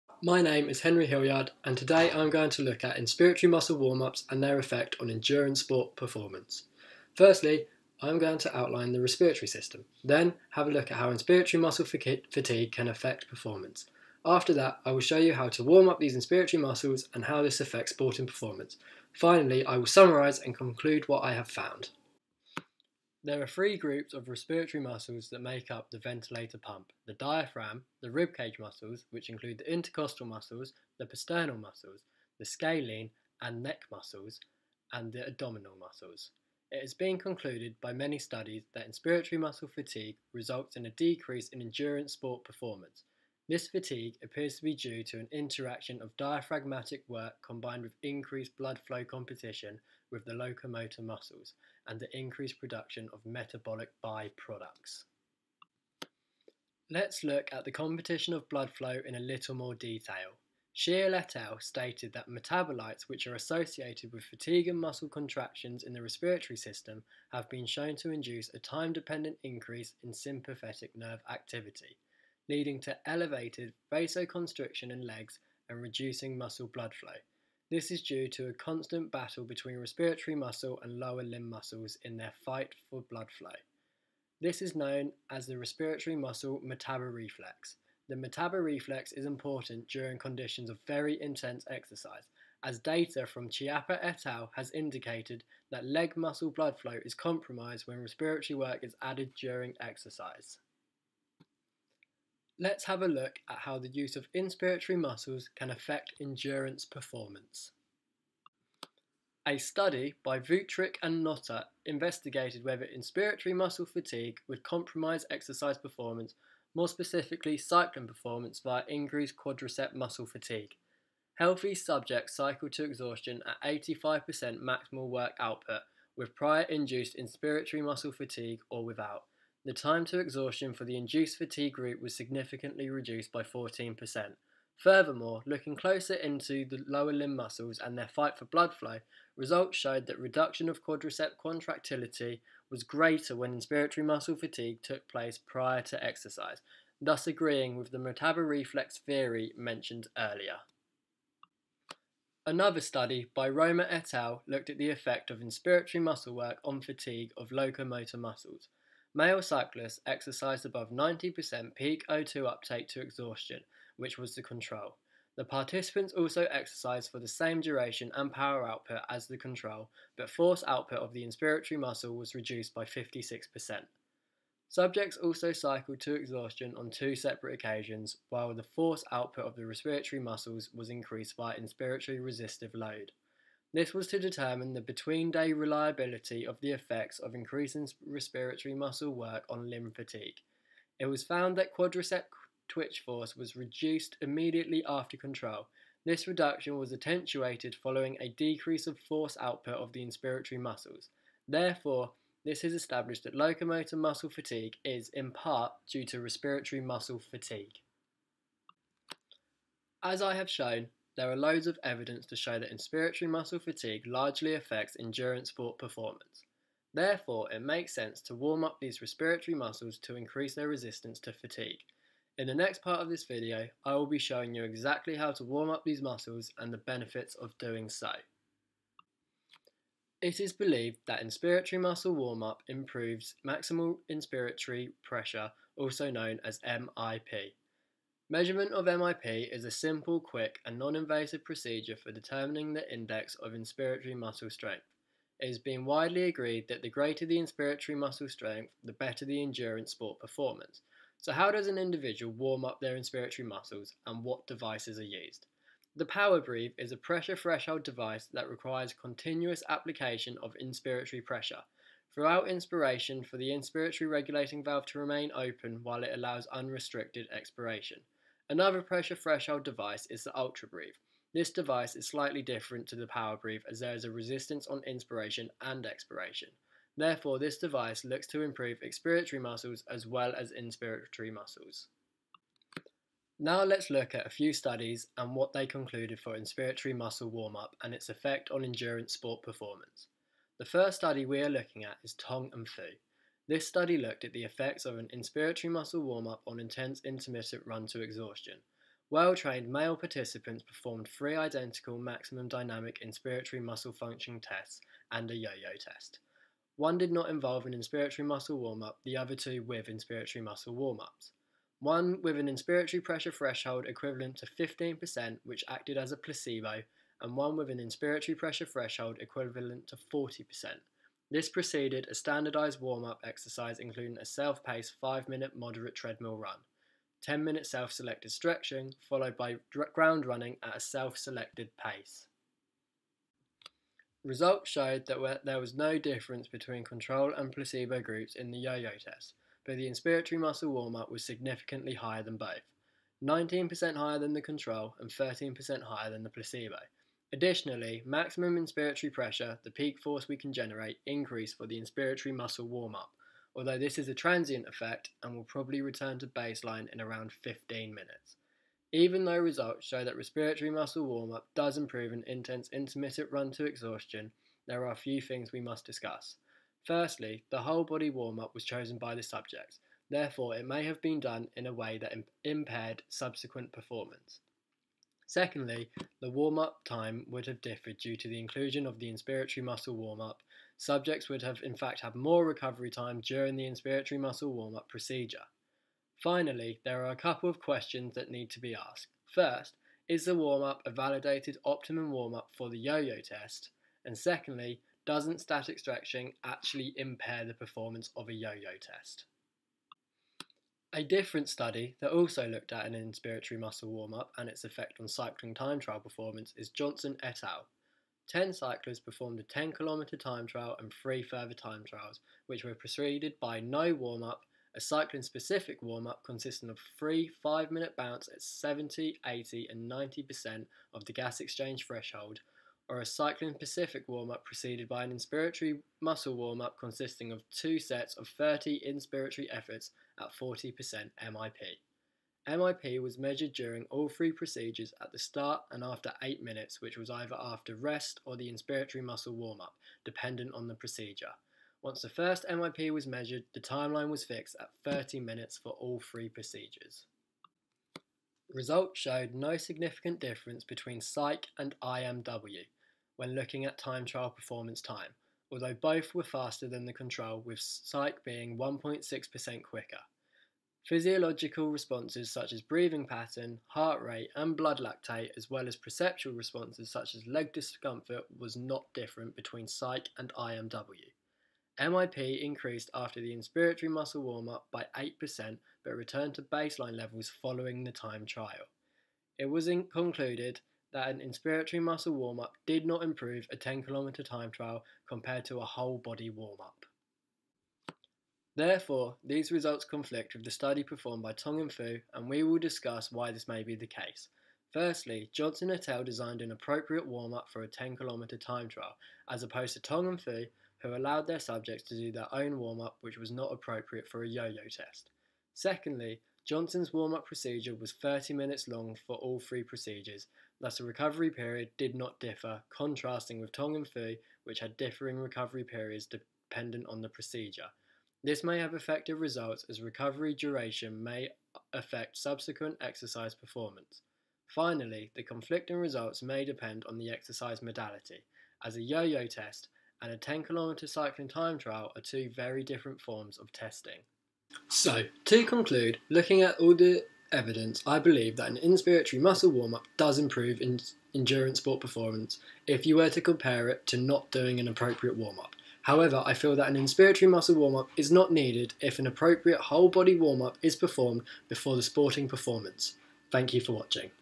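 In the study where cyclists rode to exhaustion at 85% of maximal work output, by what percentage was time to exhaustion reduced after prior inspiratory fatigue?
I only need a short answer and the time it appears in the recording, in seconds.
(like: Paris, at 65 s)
14%, at 133 s.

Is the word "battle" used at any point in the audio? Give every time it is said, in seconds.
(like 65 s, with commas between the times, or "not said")
79 s.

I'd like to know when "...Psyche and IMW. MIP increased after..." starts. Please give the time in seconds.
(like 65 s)
469 s.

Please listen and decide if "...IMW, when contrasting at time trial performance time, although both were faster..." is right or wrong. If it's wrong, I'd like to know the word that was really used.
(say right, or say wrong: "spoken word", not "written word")
wrong: "looking", not "contrasting".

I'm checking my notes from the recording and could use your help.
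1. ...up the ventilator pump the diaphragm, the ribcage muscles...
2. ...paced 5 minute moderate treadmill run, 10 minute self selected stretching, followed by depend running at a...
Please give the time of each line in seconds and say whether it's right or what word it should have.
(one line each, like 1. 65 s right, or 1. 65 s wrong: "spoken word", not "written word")
1. 25 s right
2. 324 s wrong: "ground", not "depend".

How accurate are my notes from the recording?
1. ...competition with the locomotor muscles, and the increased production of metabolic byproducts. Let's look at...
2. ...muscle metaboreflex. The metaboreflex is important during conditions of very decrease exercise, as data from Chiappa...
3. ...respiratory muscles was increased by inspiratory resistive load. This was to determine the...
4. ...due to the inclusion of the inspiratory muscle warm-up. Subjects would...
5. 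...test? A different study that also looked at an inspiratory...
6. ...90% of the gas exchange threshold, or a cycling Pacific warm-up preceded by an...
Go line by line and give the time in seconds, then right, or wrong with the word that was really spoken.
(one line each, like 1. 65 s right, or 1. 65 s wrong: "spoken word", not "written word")
1. 49 s right
2. 86 s wrong: "intense", not "decrease"
3. 179 s right
4. 377 s right
5. 398 s right
6. 419 s right.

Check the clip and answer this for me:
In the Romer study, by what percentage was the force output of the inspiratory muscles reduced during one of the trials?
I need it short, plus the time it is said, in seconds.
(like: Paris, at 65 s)
56%, at 172 s.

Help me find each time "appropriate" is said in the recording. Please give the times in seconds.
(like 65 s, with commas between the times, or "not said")
496 s, 503 s, 544 s, 549 s.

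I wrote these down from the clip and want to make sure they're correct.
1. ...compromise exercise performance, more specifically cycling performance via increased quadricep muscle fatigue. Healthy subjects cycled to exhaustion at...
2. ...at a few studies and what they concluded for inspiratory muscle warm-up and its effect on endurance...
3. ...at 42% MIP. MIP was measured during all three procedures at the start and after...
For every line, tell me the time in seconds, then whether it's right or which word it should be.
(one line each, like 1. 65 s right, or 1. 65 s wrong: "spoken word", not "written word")
1. 114 s right
2. 284 s right
3. 430 s wrong: "40", not "42".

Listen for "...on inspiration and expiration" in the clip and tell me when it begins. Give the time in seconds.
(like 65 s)
274 s.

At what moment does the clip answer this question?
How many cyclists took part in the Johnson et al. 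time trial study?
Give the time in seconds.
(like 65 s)
408 s.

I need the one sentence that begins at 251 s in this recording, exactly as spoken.
So how does an individual warm up their inspiratory muscles and what devices are used?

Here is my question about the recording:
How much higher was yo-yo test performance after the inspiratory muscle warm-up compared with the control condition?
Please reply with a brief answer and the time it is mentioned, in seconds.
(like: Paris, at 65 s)
19%, at 343 s.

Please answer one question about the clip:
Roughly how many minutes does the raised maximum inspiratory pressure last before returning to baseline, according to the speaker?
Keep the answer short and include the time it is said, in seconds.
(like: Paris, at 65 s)
15 minutes, at 357 s.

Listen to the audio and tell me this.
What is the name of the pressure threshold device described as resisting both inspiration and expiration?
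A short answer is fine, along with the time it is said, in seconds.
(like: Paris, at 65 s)
UltraBreathe, at 270 s.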